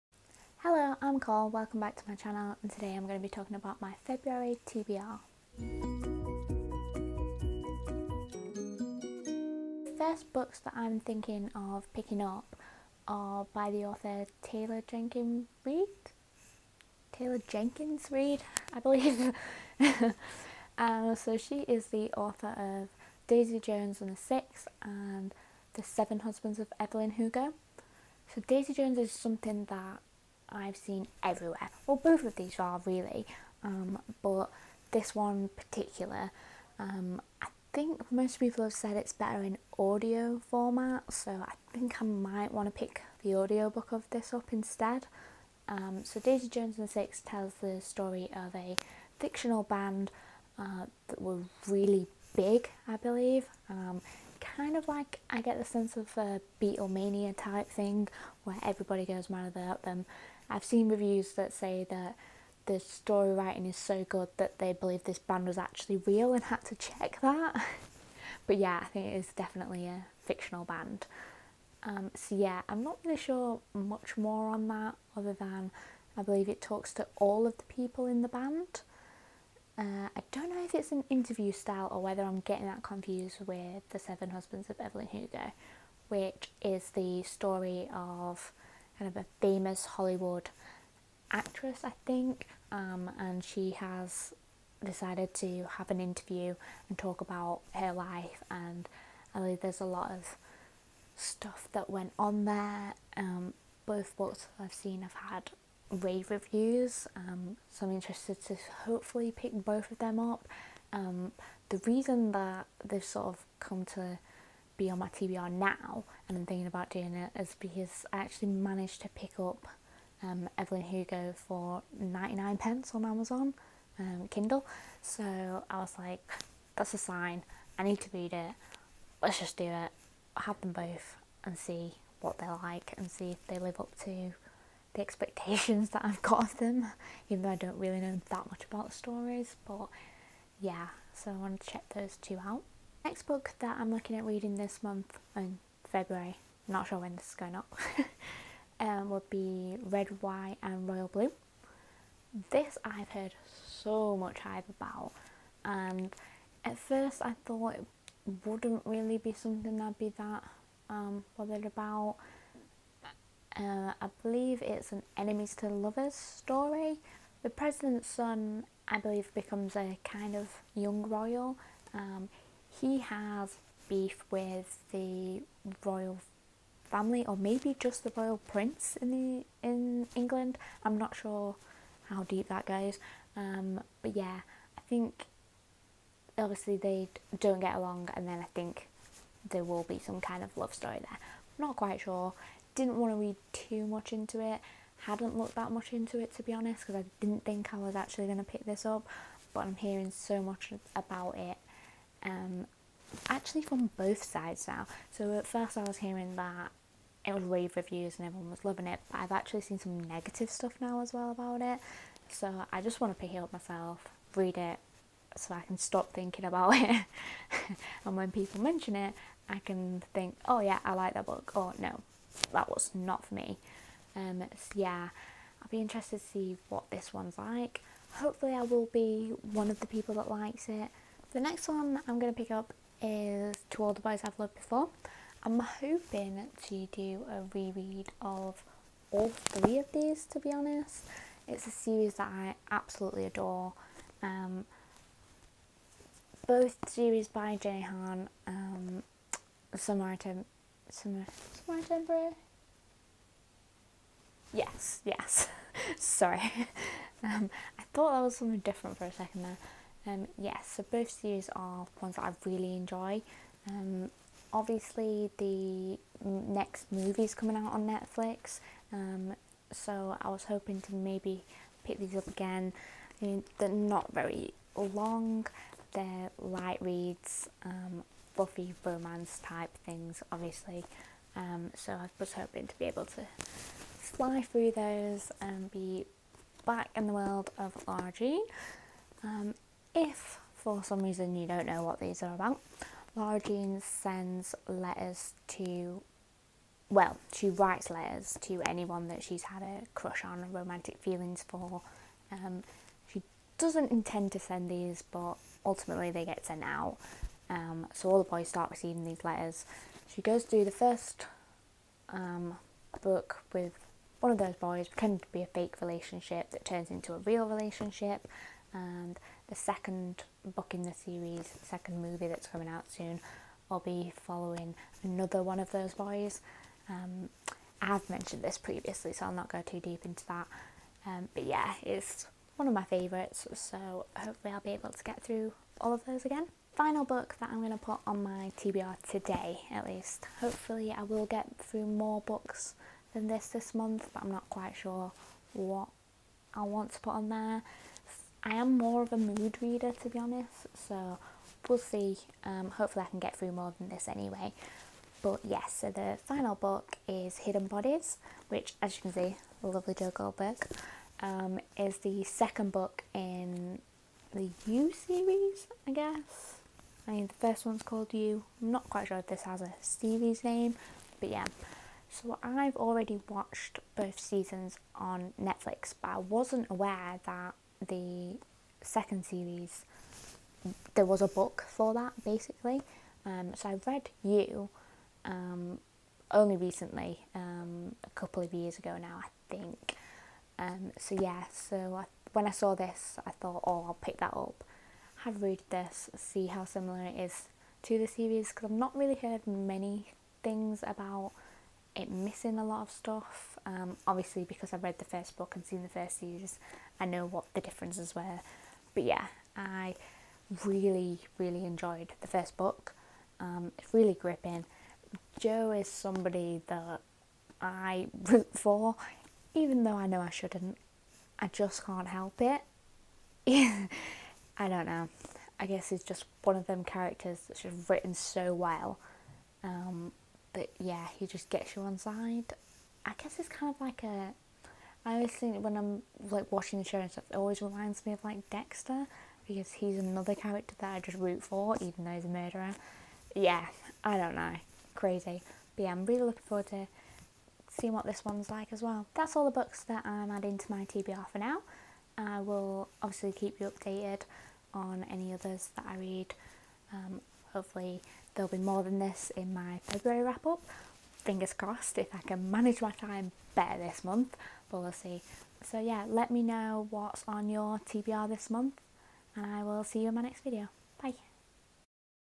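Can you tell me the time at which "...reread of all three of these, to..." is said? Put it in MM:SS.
03:57.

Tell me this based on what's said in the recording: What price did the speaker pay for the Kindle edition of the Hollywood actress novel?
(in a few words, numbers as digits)
99 pence.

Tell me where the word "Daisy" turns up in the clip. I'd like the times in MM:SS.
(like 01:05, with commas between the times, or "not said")
00:23, 00:28, 00:46.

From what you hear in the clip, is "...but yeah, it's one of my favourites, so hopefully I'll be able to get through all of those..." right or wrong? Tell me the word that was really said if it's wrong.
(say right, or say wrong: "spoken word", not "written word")
right.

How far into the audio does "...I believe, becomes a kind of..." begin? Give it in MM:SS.
02:48.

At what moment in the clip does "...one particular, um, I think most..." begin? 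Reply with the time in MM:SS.
00:35.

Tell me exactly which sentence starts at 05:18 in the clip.
And the second book in the series, second movie that's coming out soon, I'll be following another one of those boys.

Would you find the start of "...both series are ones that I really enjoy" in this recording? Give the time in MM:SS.
04:20.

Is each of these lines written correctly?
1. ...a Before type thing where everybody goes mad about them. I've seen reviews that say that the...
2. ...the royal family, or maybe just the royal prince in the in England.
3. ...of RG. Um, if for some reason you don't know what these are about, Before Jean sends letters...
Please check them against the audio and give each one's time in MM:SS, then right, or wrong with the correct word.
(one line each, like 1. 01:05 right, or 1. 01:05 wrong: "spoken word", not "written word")
1. 00:56 wrong: "Beatlemania", not "Before"
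2. 02:54 right
3. 04:47 wrong: "Lara", not "Before".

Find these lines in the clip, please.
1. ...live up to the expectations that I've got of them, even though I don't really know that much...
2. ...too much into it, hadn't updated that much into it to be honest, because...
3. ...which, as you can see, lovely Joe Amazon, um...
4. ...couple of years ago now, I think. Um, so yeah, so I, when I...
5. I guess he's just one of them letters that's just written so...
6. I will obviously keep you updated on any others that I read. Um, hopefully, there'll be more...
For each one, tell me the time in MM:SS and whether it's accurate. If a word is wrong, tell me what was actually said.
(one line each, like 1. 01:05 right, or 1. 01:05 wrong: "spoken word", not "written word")
1. 02:13 right
2. 03:13 wrong: "looked", not "updated"
3. 05:58 wrong: "Goldberg", not "Amazon"
4. 06:28 right
5. 07:05 wrong: "characters", not "letters"
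6. 07:32 right.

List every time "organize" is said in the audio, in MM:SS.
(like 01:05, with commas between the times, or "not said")
not said.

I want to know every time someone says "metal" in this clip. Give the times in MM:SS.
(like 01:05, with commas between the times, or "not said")
not said.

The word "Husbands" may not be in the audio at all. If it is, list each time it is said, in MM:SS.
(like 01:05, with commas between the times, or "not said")
00:26, 01:24.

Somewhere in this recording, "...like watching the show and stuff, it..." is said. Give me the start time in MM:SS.
07:16.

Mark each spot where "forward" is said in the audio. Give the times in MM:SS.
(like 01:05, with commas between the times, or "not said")
07:26.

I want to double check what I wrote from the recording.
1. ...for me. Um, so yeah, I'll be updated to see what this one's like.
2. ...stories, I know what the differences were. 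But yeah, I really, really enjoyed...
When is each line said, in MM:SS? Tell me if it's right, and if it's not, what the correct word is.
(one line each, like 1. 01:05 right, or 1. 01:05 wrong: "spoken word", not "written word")
1. 03:43 wrong: "interested", not "updated"
2. 06:46 wrong: "series", not "stories".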